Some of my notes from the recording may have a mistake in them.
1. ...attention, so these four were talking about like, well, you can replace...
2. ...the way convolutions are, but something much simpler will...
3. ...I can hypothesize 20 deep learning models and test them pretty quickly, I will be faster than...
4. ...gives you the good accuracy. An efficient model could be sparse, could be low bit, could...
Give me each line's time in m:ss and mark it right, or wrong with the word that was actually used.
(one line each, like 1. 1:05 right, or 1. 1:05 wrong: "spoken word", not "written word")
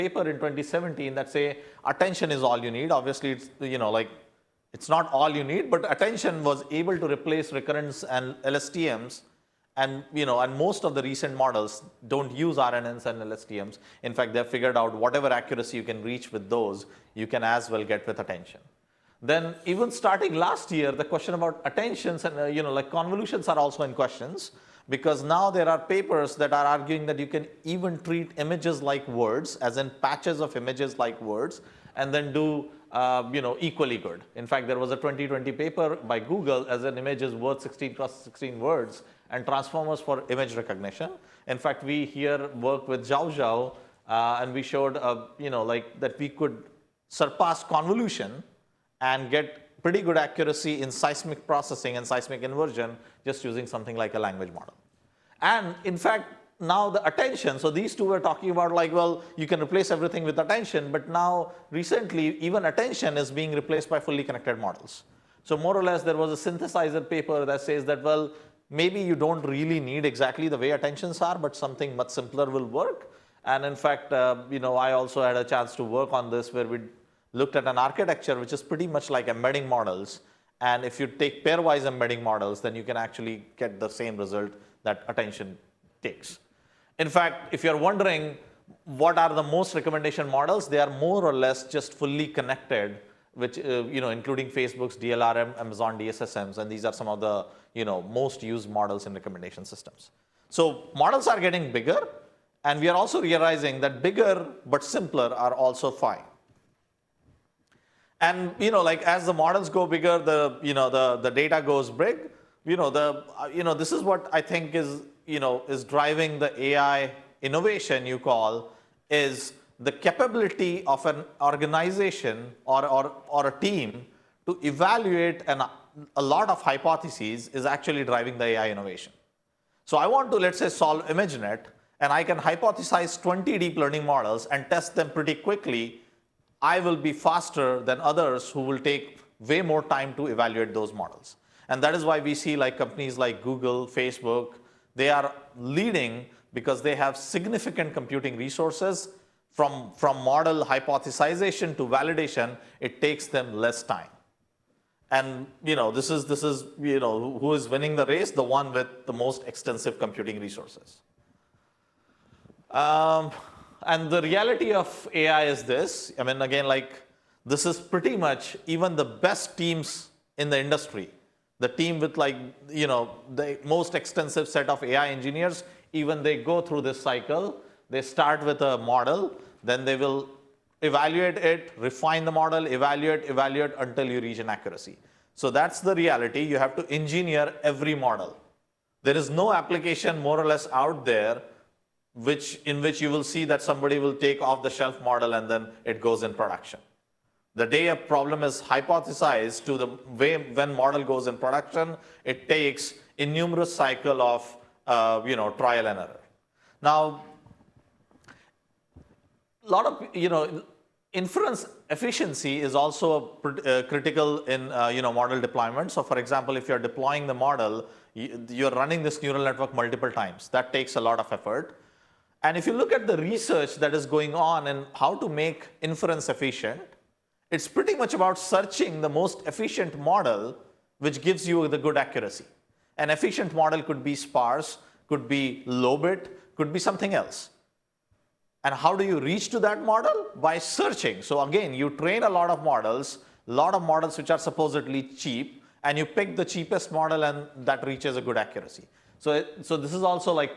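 1. 0:57 wrong: "two", not "four"
2. 1:10 wrong: "attentions", not "convolutions"
3. 2:12 right
4. 3:51 right.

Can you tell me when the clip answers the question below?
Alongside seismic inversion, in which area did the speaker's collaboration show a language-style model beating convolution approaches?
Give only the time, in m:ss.
0:50.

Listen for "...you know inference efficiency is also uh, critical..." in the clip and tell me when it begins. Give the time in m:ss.
3:30.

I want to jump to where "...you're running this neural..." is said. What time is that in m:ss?
3:38.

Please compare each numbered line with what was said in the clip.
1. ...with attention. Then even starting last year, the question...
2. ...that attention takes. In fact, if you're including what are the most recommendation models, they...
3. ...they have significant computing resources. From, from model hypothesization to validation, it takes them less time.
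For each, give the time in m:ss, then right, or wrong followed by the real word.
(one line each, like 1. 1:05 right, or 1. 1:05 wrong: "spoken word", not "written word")
1. 0:18 right
2. 1:24 wrong: "wondering", not "including"
3. 2:26 right.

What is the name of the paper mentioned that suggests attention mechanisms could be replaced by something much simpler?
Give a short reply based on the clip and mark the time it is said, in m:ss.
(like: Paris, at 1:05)
synthesizer, at 1:06.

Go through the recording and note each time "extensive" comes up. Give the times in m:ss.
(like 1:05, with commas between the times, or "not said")
2:39, 2:53.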